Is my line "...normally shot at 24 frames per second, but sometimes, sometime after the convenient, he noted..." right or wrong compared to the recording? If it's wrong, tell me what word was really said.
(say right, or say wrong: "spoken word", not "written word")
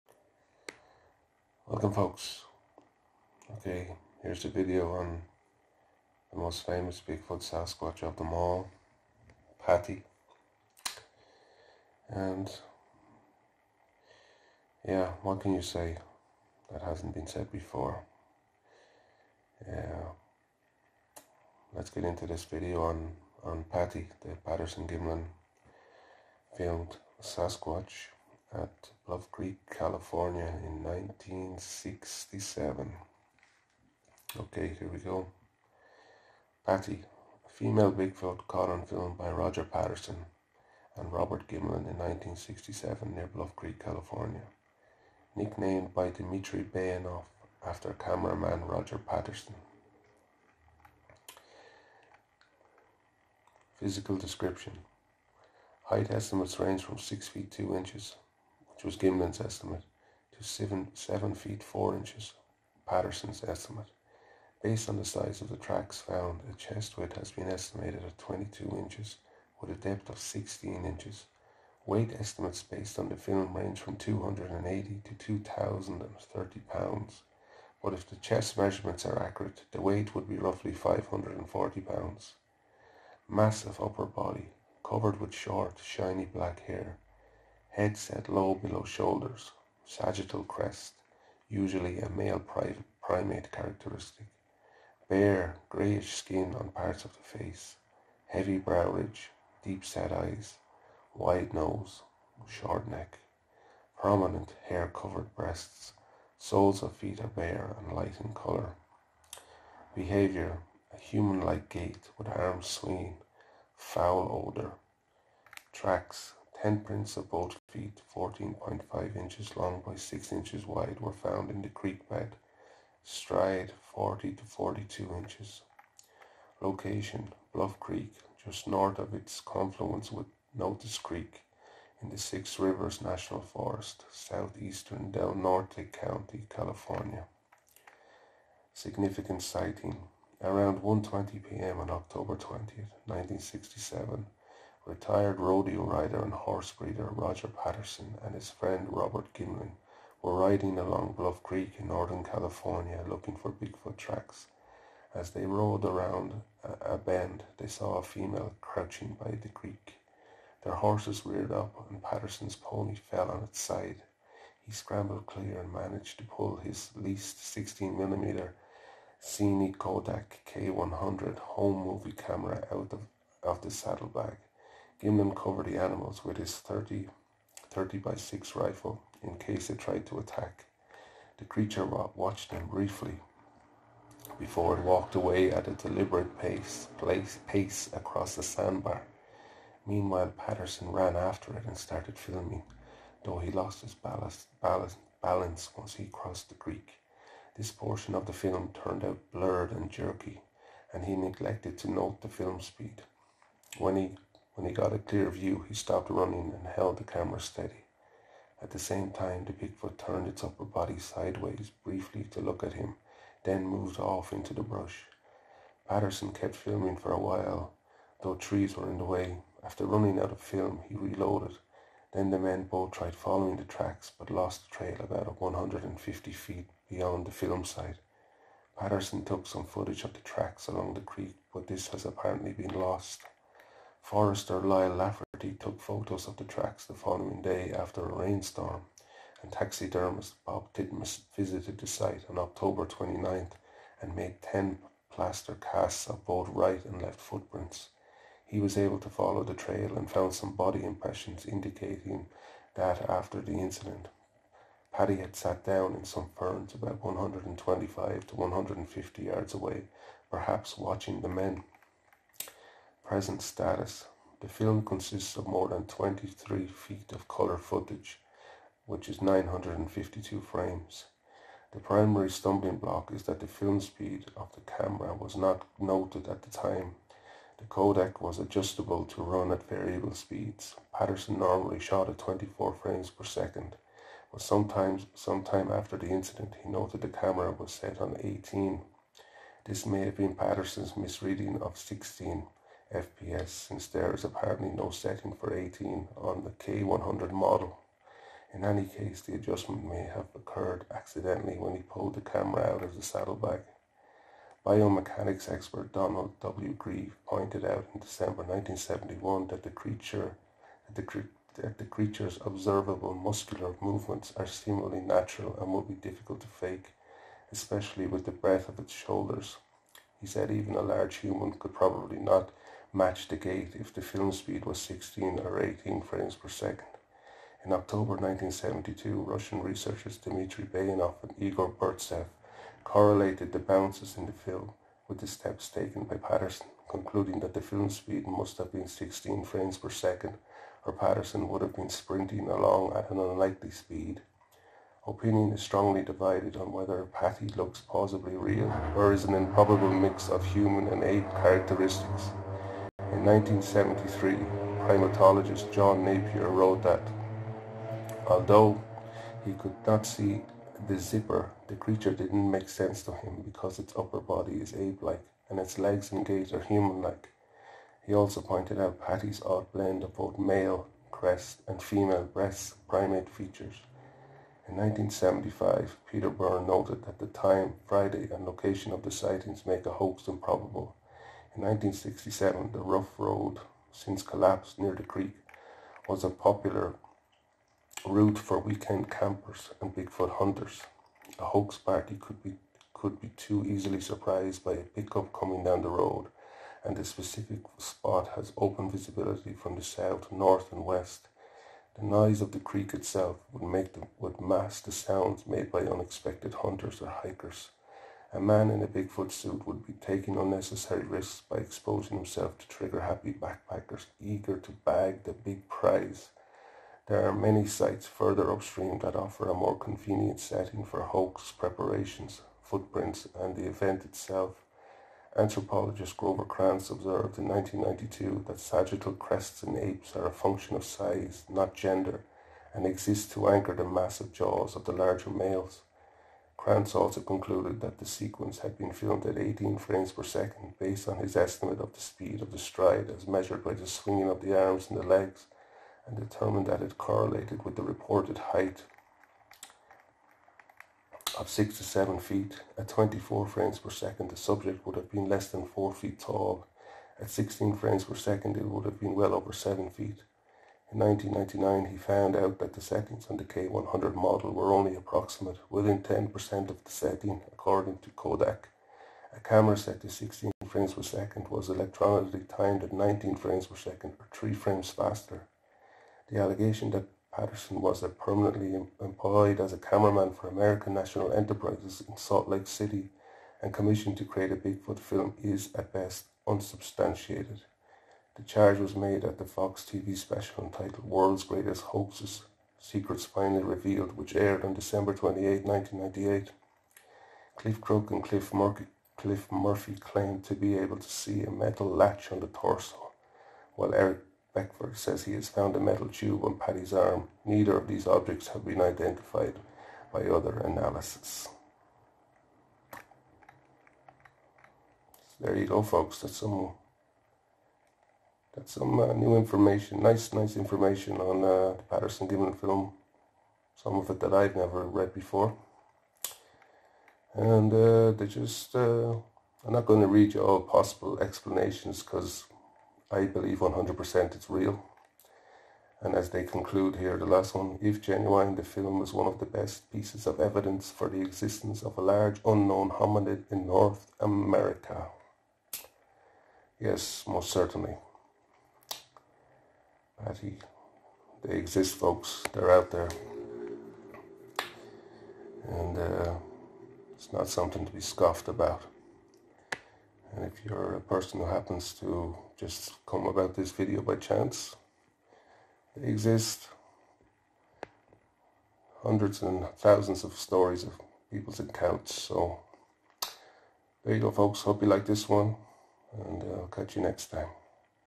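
wrong: "incident", not "convenient".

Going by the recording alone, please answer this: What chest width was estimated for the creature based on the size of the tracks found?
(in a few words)
22 inches.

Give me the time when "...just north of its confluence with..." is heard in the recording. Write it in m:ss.
2:08.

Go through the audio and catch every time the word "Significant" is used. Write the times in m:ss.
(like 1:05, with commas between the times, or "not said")
2:18.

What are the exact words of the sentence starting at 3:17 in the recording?
This portion of the film turned out blurred and jerky, and he neglected to note the film speed.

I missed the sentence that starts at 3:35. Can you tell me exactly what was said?
Patterson kept filming for a while, though trees were in the way.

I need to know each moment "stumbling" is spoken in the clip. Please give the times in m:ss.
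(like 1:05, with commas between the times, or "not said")
4:32.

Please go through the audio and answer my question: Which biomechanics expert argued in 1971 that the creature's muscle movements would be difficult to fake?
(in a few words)
Donald W. Grieve.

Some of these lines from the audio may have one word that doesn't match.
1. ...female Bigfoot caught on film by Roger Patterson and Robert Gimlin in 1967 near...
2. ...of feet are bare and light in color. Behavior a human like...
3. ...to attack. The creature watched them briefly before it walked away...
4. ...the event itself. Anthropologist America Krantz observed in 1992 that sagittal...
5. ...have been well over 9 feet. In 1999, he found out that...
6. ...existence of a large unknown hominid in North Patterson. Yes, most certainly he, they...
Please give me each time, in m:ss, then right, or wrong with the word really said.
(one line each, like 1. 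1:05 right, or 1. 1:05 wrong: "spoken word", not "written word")
1. 0:37 right
2. 1:46 right
3. 3:00 right
4. 7:03 wrong: "Grover", not "America"
5. 7:38 wrong: "7", not "9"
6. 9:01 wrong: "America", not "Patterson".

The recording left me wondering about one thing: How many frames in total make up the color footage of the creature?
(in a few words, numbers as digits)
952.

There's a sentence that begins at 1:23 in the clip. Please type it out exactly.
Massive upper body, covered with short, shiny black hair, Head set low below shoulders.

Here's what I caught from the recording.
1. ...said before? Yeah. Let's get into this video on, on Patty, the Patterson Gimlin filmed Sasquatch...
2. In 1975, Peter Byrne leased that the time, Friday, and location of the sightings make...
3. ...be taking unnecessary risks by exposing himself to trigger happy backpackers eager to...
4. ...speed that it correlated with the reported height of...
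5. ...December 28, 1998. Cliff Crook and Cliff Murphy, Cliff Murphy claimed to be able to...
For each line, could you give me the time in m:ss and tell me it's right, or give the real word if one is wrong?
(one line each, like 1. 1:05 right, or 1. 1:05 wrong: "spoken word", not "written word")
1. 0:17 right
2. 6:14 wrong: "noted", not "leased"
3. 6:49 right
4. 7:26 wrong: "determined", not "speed"
5. 8:14 right.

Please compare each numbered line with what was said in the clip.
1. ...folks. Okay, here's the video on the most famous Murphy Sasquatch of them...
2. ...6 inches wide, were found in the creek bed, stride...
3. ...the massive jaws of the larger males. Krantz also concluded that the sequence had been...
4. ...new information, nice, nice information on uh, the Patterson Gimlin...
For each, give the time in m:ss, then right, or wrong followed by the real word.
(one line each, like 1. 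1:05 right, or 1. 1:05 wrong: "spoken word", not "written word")
1. 0:01 wrong: "Bigfoot", not "Murphy"
2. 1:59 right
3. 7:13 right
4. 8:39 right.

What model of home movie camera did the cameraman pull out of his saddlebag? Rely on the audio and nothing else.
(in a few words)
Cine-Kodak K100.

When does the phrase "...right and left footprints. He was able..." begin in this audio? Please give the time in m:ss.
4:06.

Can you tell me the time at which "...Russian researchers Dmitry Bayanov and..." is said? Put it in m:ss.
5:29.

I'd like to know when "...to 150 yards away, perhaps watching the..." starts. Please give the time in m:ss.
4:18.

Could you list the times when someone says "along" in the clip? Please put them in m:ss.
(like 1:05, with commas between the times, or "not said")
2:30, 3:50, 5:42.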